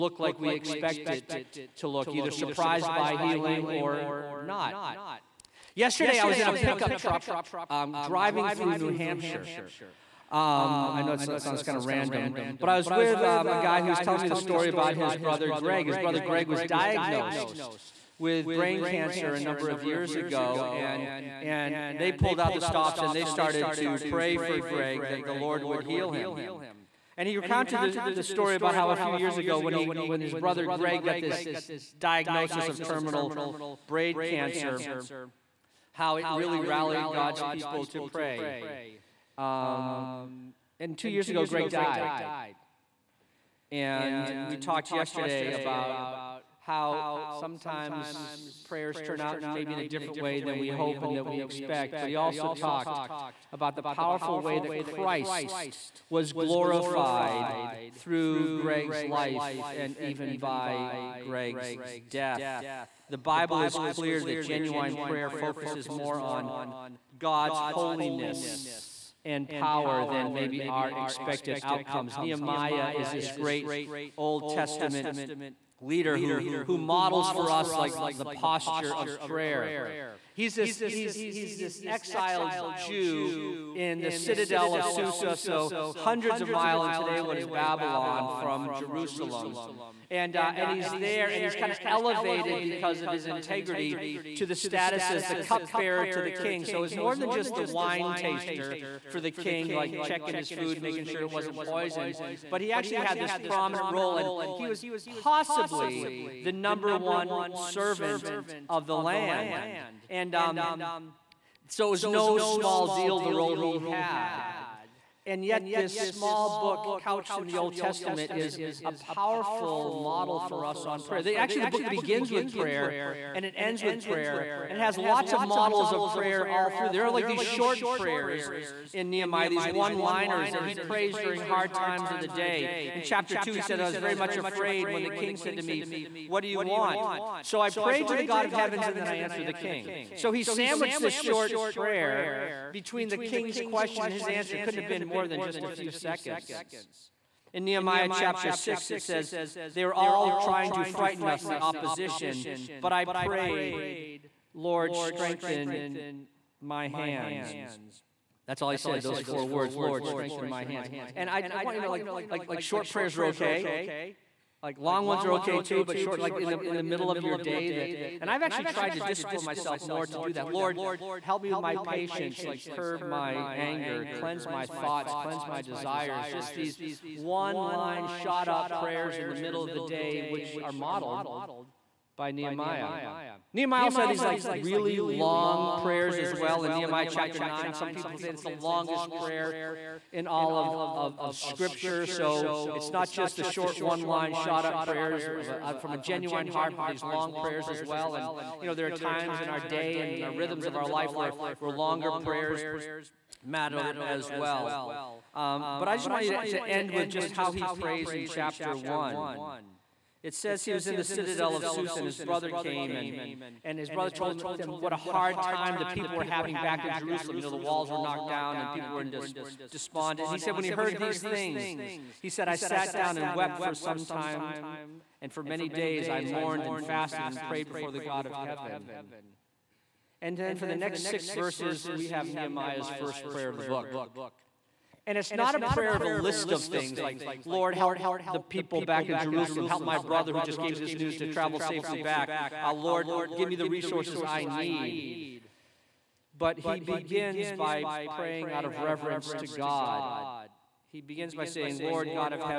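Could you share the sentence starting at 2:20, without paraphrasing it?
So he sandwiched this short prayer between the king's question and his answer.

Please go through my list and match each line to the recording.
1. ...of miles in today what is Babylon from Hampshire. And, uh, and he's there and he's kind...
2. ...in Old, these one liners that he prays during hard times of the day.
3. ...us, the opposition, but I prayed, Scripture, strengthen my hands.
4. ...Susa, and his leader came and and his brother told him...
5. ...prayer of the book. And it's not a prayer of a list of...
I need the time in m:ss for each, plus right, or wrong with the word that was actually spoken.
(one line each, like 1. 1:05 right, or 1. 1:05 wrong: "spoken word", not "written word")
1. 1:26 wrong: "Jerusalem", not "Hampshire"
2. 2:08 wrong: "Nehemiah", not "Old"
3. 2:31 wrong: "Lord", not "Scripture"
4. 3:31 wrong: "brother", not "leader"
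5. 3:53 right.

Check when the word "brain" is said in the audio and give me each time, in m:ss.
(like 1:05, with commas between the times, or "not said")
0:18, 0:33.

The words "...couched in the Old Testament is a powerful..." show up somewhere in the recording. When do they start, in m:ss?
1:56.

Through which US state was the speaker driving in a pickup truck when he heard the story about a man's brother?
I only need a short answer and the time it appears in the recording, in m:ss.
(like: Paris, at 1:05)
New Hampshire, at 0:08.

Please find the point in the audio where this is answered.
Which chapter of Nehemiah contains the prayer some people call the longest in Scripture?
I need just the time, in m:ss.
3:07.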